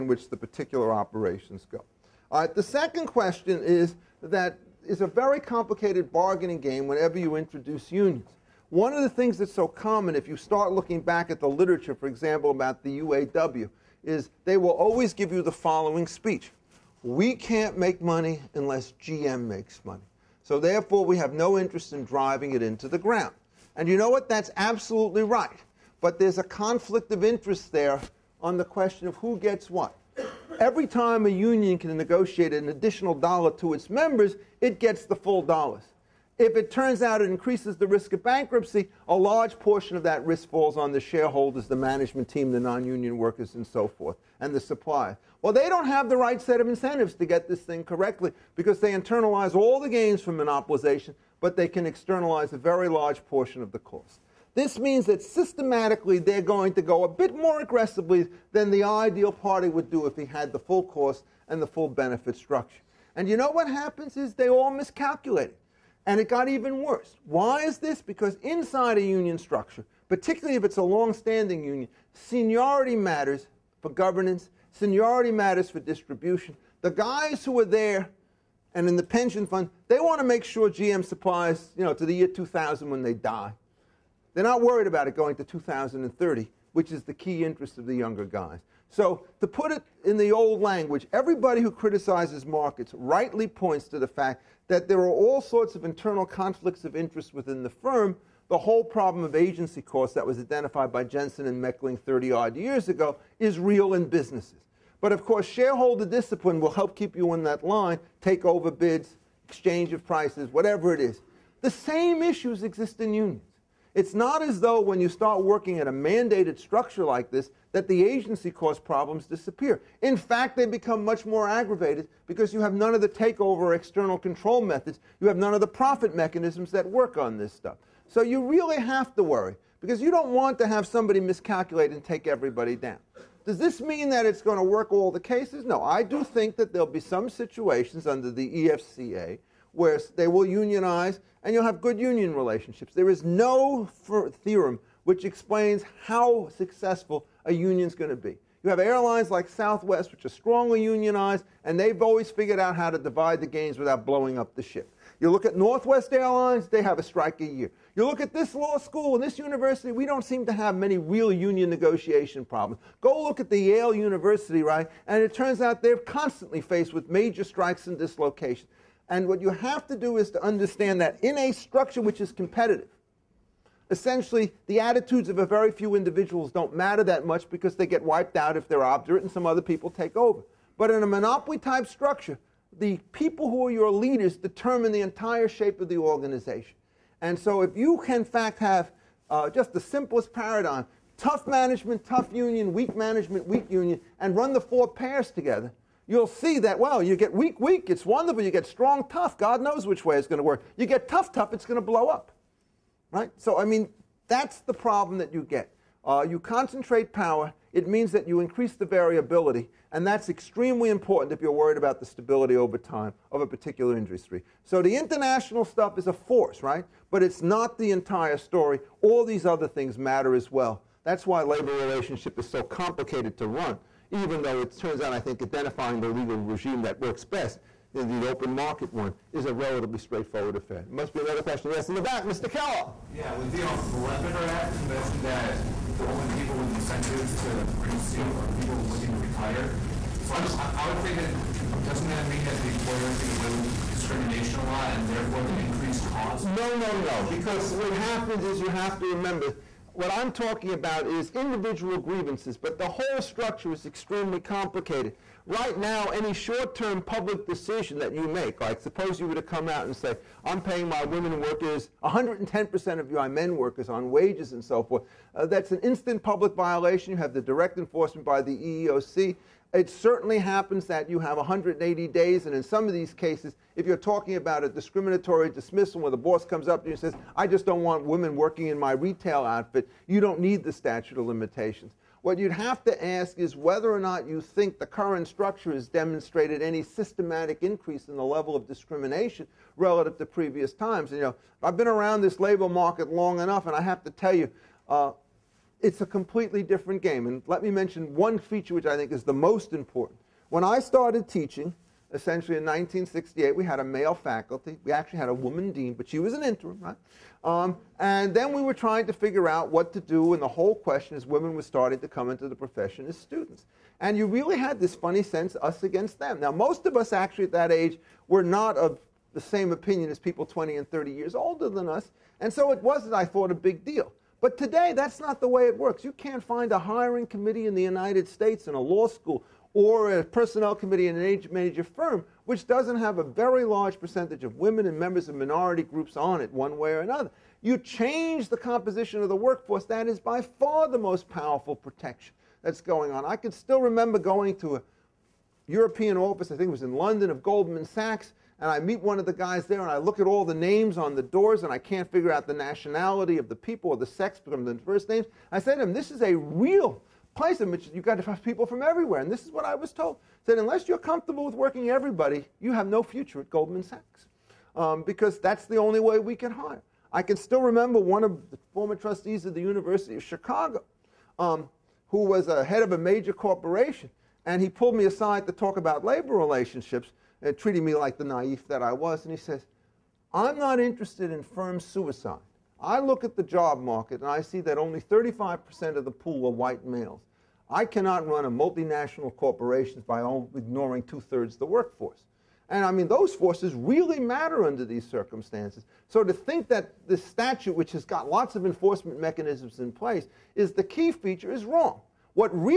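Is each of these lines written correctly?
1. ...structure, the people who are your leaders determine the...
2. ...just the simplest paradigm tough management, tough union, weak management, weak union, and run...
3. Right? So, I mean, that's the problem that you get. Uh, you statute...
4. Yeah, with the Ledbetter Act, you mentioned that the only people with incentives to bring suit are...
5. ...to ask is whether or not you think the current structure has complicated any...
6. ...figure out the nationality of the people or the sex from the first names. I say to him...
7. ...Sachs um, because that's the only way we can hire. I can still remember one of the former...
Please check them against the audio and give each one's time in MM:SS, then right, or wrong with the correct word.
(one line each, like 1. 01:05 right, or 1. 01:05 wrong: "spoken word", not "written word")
1. 03:01 right
2. 03:09 right
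3. 03:23 wrong: "concentrate", not "statute"
4. 03:53 right
5. 04:42 wrong: "demonstrated", not "complicated"
6. 05:52 right
7. 06:03 right.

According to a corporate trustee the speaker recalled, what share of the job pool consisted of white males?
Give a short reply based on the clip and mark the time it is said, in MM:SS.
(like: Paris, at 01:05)
35%, at 06:24.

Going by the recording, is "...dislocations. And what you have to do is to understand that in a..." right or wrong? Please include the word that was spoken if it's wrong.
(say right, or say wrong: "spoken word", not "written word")
right.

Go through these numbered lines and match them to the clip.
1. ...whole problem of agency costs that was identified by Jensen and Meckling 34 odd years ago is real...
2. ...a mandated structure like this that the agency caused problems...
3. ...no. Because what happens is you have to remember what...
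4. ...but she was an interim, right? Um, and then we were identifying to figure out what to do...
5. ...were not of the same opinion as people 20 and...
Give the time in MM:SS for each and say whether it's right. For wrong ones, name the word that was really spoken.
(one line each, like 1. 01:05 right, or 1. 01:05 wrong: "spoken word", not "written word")
1. 01:38 wrong: "30", not "34"
2. 01:55 right
3. 04:06 right
4. 05:05 wrong: "trying", not "identifying"
5. 05:18 right.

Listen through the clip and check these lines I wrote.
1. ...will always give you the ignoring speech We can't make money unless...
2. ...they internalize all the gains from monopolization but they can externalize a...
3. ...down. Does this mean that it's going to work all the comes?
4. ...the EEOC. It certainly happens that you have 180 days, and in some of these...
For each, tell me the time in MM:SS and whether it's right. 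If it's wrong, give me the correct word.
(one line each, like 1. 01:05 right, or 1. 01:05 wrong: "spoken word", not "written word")
1. 00:14 wrong: "following", not "ignoring"
2. 00:48 right
3. 02:12 wrong: "cases", not "comes"
4. 04:28 right.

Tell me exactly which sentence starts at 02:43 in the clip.
Go look at the Yale University, right?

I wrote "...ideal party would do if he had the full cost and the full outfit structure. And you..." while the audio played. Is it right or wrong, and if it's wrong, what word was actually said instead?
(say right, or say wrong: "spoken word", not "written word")
wrong: "benefit", not "outfit".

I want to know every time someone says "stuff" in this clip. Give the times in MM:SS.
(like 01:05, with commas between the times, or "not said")
02:07, 03:35.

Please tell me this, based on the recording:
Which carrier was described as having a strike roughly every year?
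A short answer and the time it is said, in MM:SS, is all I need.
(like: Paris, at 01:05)
Northwest Airlines, at 02:35.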